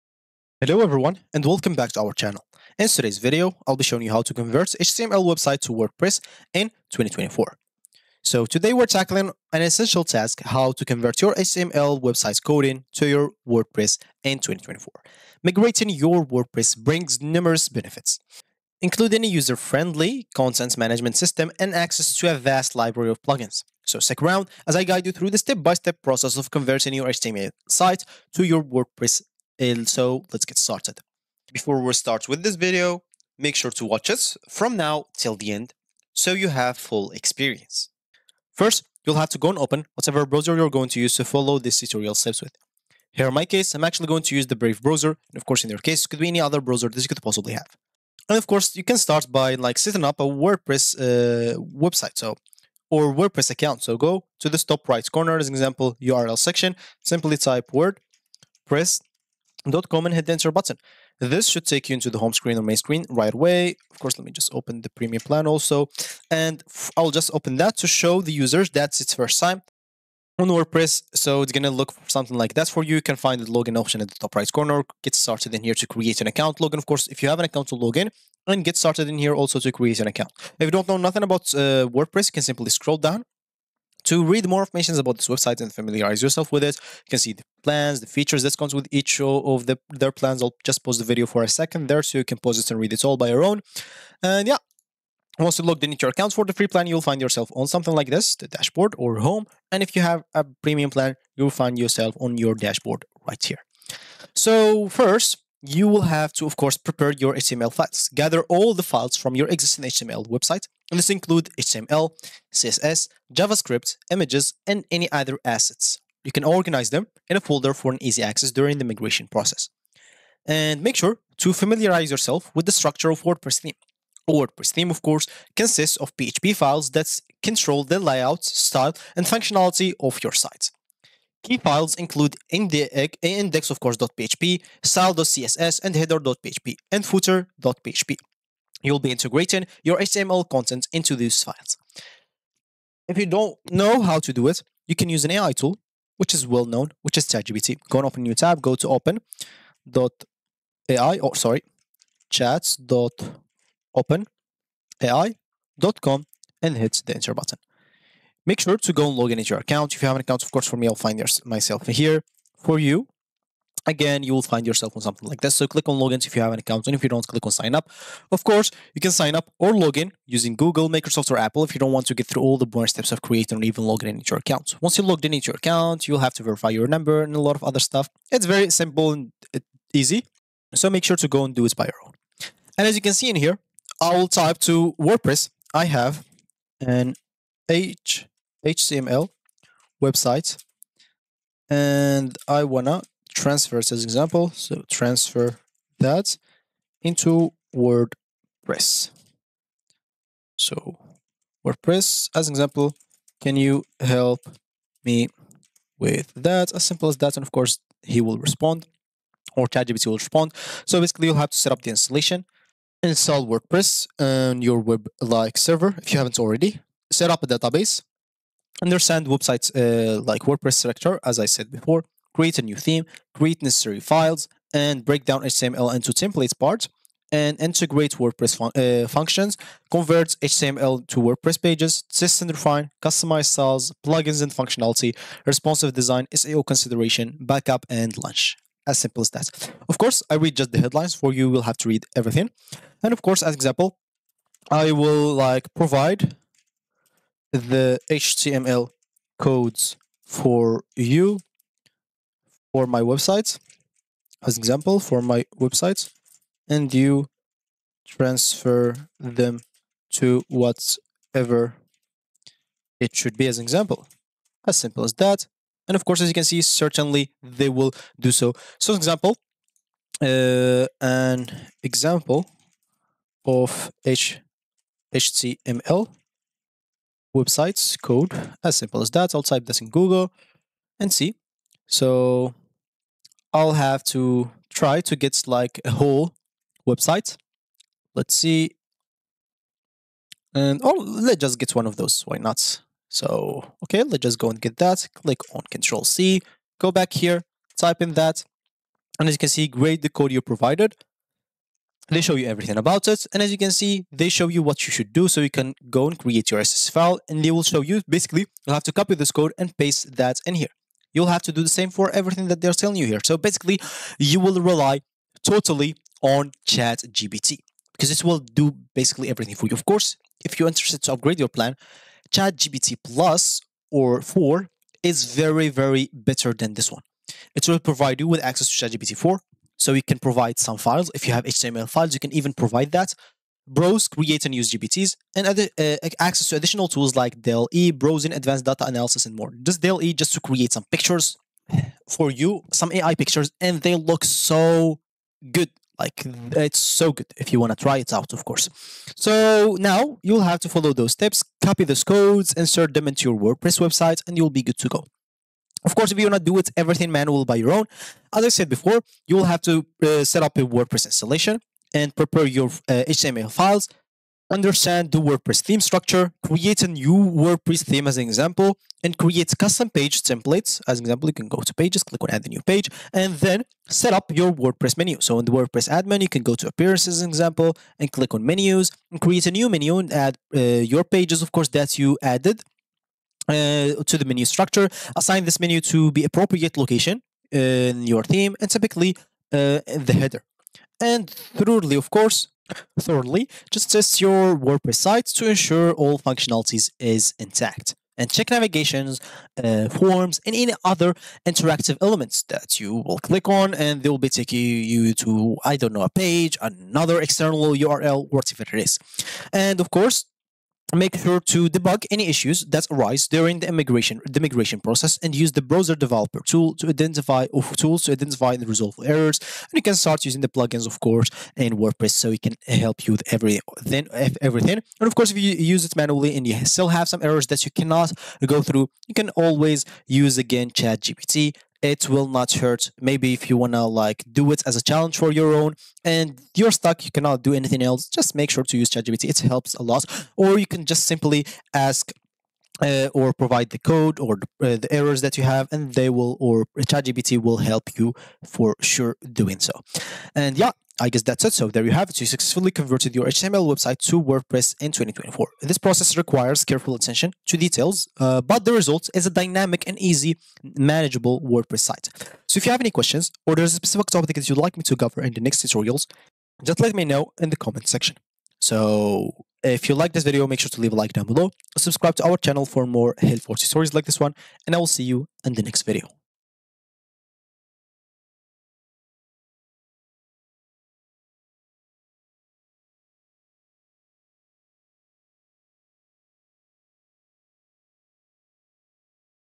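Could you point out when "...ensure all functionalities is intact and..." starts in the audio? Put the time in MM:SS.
06:35.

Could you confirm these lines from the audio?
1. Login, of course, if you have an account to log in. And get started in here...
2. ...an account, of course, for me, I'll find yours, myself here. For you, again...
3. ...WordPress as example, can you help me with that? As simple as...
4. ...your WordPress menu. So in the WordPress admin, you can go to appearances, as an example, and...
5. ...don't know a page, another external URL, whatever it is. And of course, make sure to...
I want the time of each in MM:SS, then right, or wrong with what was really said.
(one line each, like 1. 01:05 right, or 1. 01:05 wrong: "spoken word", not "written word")
1. 01:16 right
2. 02:40 right
3. 03:21 right
4. 06:14 right
5. 06:45 right.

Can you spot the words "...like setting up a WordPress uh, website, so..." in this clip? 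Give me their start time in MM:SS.
00:49.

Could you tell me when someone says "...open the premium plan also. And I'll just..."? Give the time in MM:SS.
01:04.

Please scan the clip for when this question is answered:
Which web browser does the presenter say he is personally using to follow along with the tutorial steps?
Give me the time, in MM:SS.
00:44.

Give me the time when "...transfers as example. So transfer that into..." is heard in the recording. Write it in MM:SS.
03:13.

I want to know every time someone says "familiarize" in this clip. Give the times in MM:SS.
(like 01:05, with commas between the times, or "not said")
01:25, 02:01.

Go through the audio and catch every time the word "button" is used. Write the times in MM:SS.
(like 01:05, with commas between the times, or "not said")
01:00, 02:37.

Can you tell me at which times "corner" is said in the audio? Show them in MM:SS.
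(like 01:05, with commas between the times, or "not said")
00:55, 01:14.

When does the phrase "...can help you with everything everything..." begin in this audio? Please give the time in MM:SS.
07:02.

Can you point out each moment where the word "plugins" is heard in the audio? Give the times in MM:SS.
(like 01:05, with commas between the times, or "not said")
00:23, 03:54, 07:00.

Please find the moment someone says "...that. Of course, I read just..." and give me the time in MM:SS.
03:59.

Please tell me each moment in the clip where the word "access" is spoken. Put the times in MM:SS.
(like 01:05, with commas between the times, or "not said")
00:21, 01:58, 05:28, 05:36.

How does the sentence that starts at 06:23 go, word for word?
Uh, to the menu structure, assign this menu to be appropriate location in your theme and typically uh, the header.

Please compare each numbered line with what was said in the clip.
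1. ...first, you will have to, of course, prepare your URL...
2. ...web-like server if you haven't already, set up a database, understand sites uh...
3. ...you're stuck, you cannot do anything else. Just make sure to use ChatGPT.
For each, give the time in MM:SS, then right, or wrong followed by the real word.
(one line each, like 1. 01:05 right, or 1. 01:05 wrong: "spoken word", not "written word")
1. 01:44 wrong: "HTML", not "URL"
2. 03:34 wrong: "websites", not "sites"
3. 07:16 right.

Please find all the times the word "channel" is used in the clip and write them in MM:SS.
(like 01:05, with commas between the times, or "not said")
00:02, 07:52.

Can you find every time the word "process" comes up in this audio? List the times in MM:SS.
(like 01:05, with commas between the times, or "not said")
00:26, 01:59, 06:54, 07:35.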